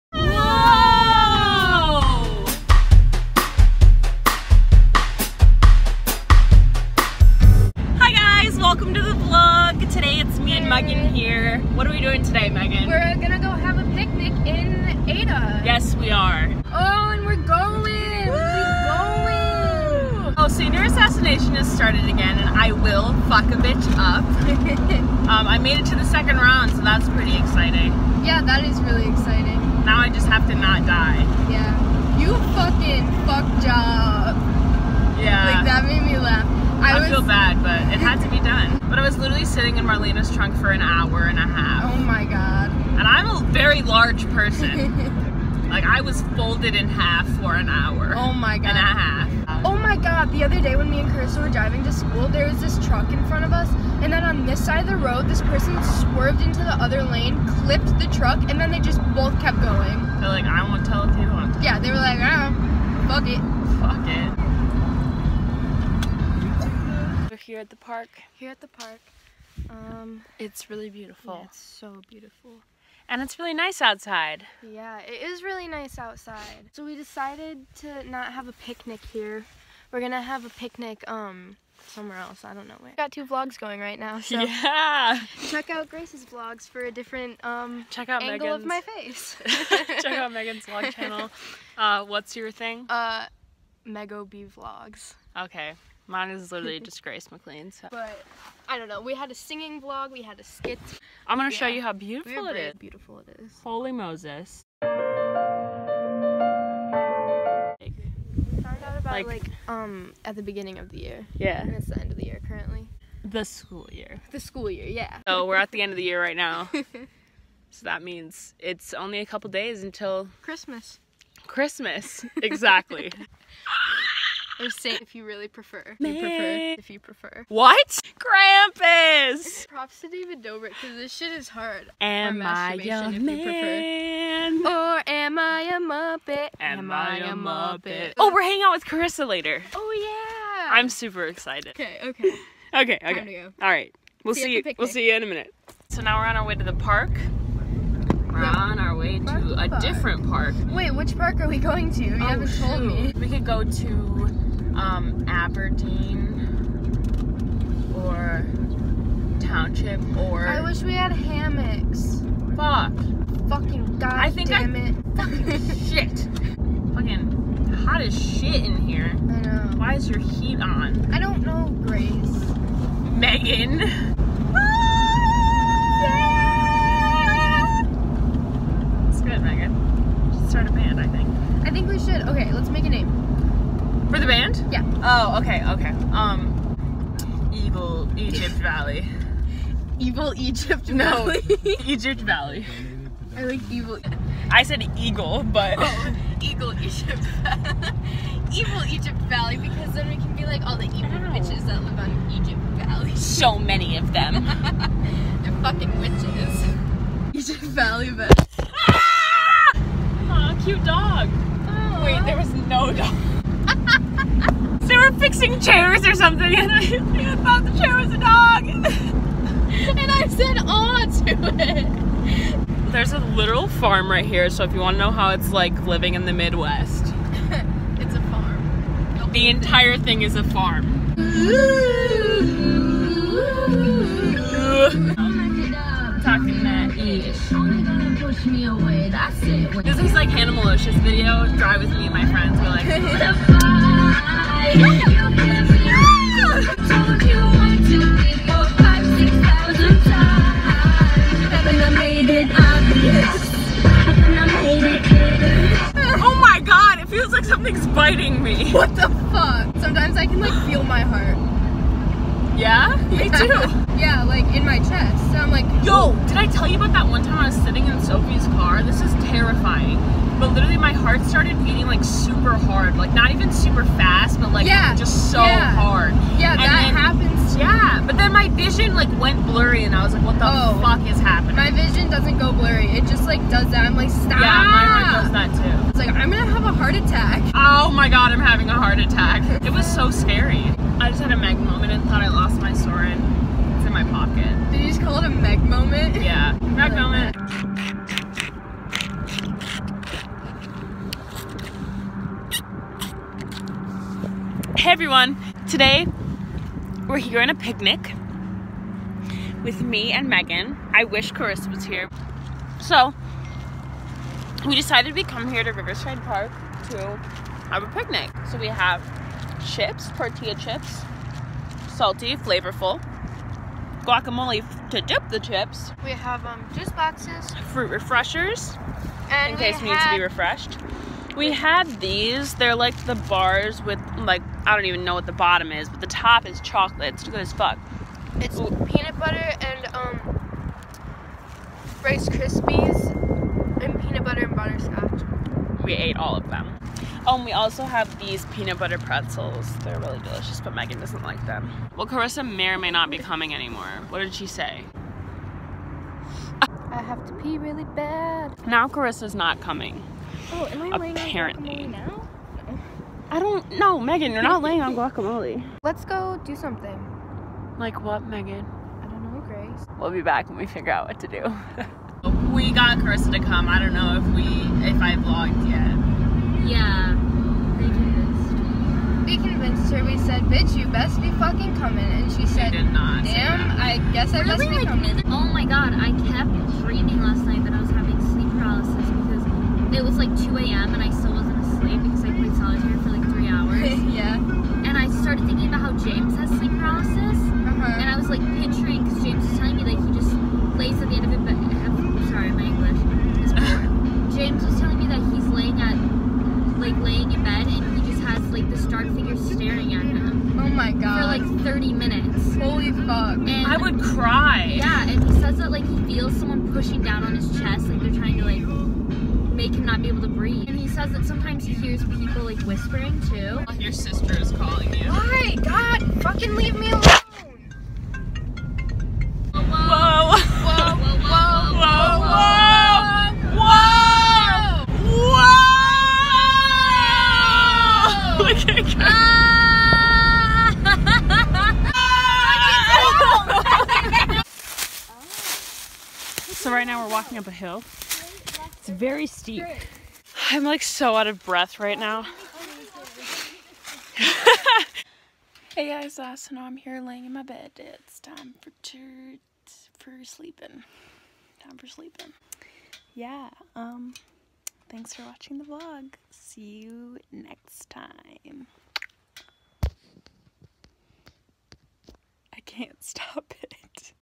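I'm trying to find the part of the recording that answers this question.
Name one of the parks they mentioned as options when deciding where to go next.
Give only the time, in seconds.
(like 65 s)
155 s.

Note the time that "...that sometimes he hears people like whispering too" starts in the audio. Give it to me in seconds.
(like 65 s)
421 s.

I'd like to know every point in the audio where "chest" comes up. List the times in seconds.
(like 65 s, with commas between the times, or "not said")
264 s, 417 s.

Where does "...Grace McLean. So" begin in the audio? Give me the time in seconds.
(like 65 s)
97 s.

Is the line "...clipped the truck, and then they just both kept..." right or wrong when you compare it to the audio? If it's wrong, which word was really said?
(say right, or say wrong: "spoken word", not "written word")
right.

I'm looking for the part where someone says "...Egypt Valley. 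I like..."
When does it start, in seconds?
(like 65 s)
191 s.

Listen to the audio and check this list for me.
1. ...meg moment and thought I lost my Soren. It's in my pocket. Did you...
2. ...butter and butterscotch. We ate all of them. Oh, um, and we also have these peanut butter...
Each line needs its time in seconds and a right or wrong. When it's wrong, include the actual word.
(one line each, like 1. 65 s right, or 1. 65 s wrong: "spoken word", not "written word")
1. 291 s right
2. 344 s right.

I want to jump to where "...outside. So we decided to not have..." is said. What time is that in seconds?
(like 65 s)
75 s.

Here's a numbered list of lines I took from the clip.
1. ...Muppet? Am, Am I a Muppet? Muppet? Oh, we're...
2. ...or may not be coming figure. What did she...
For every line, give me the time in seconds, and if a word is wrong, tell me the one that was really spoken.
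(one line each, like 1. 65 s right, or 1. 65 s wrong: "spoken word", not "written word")
1. 135 s right
2. 352 s wrong: "anymore", not "figure".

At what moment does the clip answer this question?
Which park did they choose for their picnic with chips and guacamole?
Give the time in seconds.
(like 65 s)
315 s.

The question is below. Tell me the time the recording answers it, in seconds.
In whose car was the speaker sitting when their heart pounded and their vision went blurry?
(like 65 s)
268 s.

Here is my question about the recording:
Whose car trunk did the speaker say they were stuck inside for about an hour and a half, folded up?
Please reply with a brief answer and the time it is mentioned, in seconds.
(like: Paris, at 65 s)
Marlena, at 39 s.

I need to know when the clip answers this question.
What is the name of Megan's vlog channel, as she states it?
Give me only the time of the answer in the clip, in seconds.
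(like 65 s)
93 s.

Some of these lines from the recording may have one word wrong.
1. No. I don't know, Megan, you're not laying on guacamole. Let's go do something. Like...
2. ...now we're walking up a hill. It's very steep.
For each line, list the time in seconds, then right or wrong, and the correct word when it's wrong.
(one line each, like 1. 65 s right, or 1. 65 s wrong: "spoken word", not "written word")
1. 362 s right
2. 446 s right.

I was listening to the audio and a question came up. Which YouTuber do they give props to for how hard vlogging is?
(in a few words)
David Dobrik.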